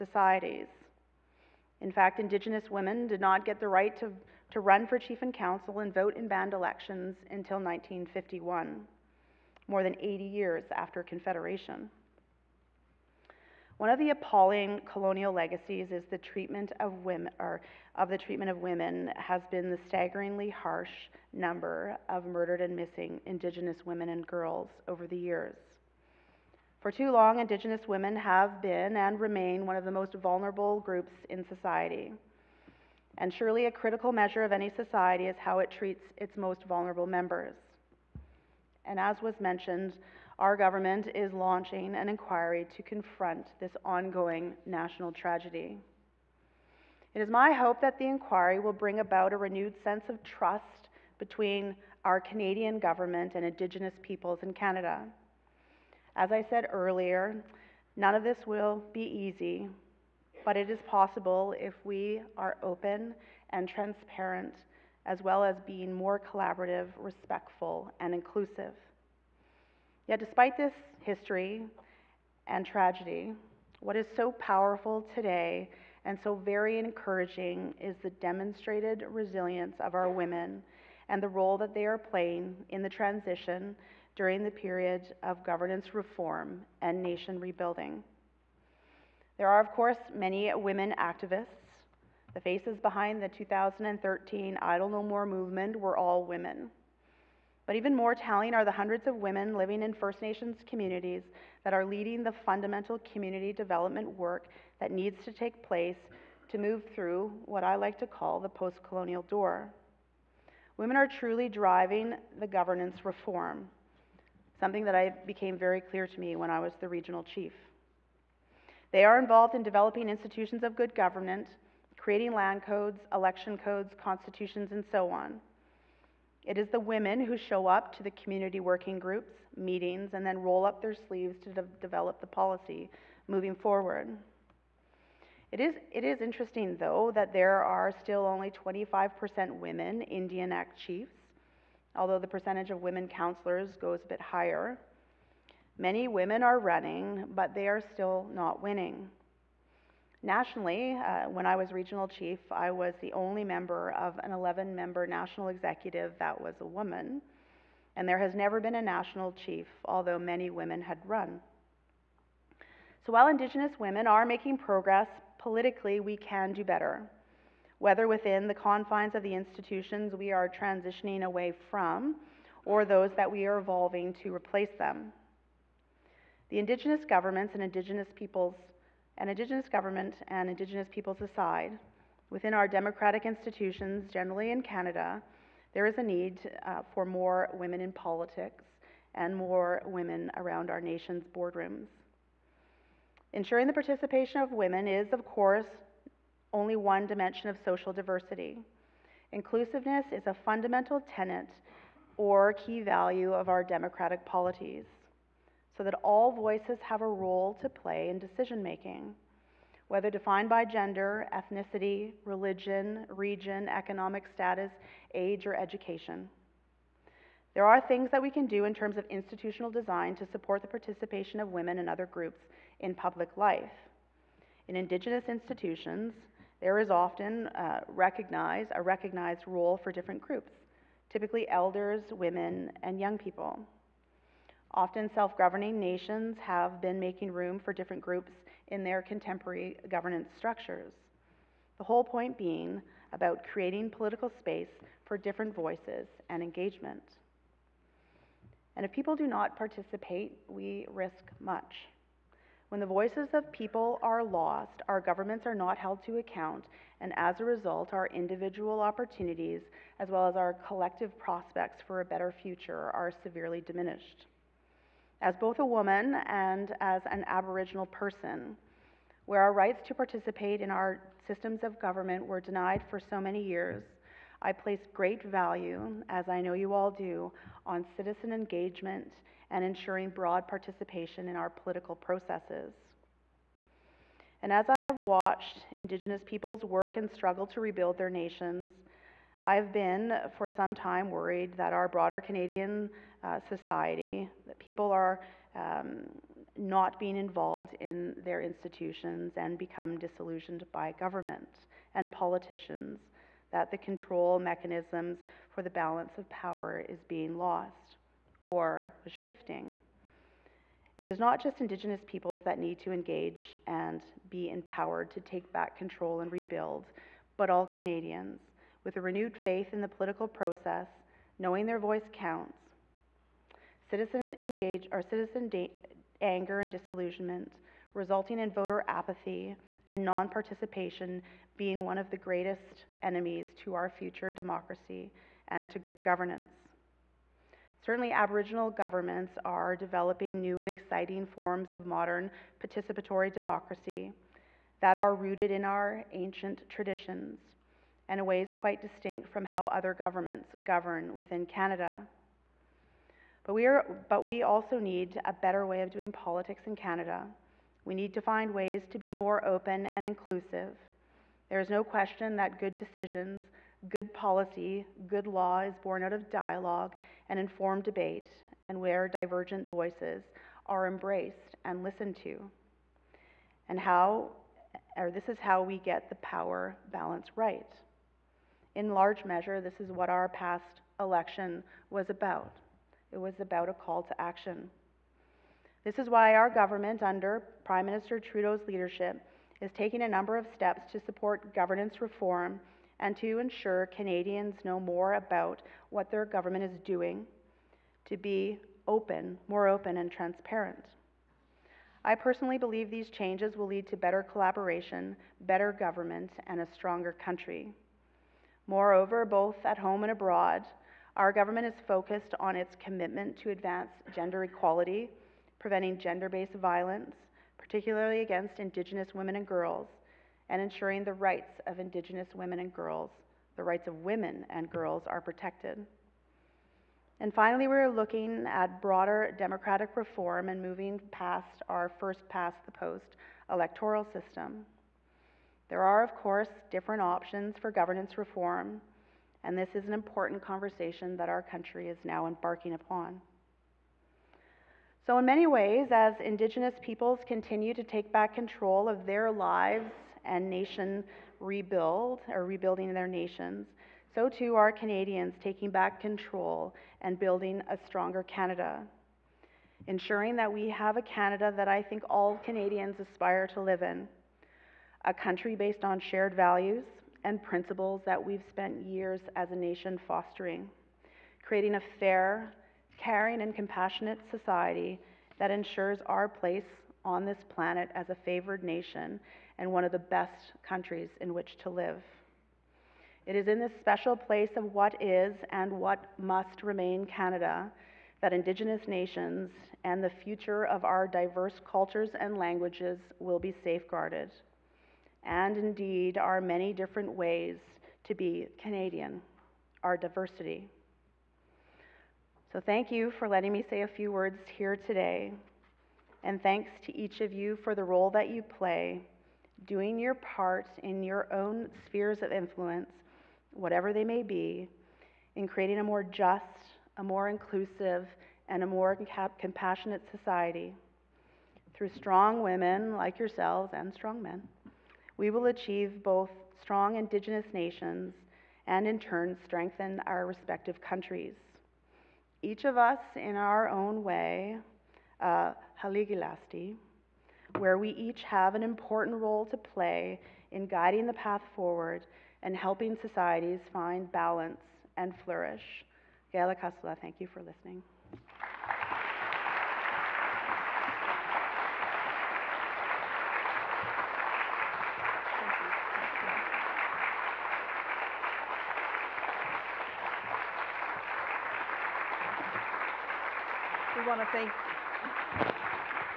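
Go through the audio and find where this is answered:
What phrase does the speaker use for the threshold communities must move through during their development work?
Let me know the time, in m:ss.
1:48.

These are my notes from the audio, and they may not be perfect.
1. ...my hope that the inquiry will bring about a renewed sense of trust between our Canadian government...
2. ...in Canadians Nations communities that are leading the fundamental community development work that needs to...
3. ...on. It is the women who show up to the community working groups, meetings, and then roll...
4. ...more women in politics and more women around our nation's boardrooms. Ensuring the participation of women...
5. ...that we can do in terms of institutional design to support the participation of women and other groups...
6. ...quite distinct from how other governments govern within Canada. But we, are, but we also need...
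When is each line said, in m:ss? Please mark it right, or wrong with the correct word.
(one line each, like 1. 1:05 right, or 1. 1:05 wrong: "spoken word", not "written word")
1. 0:47 right
2. 1:39 wrong: "First", not "Canadians"
3. 2:05 right
4. 3:07 right
5. 3:38 right
6. 5:48 right.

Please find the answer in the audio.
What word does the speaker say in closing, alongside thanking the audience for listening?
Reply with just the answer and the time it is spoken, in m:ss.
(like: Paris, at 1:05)
Gilakas'la, at 9:06.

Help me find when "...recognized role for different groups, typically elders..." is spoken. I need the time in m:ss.
3:48.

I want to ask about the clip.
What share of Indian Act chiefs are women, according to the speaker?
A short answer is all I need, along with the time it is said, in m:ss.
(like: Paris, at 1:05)
25%, at 2:18.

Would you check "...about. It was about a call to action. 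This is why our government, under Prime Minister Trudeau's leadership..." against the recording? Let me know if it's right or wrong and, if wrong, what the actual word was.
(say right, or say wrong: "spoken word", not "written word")
right.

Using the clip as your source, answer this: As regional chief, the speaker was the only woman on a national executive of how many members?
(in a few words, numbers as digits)
11.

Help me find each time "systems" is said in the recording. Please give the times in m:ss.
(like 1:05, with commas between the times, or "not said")
4:31, 7:14.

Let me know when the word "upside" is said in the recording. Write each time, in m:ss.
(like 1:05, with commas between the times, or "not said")
not said.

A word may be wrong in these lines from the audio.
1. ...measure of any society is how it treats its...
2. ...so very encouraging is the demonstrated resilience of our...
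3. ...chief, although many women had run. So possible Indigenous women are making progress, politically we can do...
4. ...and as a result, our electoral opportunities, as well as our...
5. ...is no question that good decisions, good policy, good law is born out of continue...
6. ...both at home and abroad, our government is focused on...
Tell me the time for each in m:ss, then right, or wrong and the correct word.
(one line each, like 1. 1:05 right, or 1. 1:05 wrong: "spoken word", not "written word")
1. 0:34 right
2. 1:16 right
3. 2:39 wrong: "while", not "possible"
4. 4:16 wrong: "individual", not "electoral"
5. 6:01 wrong: "dialogue", not "continue"
6. 6:49 right.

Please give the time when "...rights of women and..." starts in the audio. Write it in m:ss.
7:03.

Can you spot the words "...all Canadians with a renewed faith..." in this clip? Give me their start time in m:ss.
5:17.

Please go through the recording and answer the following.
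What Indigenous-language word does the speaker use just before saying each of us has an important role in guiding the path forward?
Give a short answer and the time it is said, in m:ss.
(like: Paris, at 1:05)
Hiligaxste', at 8:55.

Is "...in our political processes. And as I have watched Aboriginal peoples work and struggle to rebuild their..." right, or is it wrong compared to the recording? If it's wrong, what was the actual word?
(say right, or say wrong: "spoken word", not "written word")
wrong: "Indigenous", not "Aboriginal".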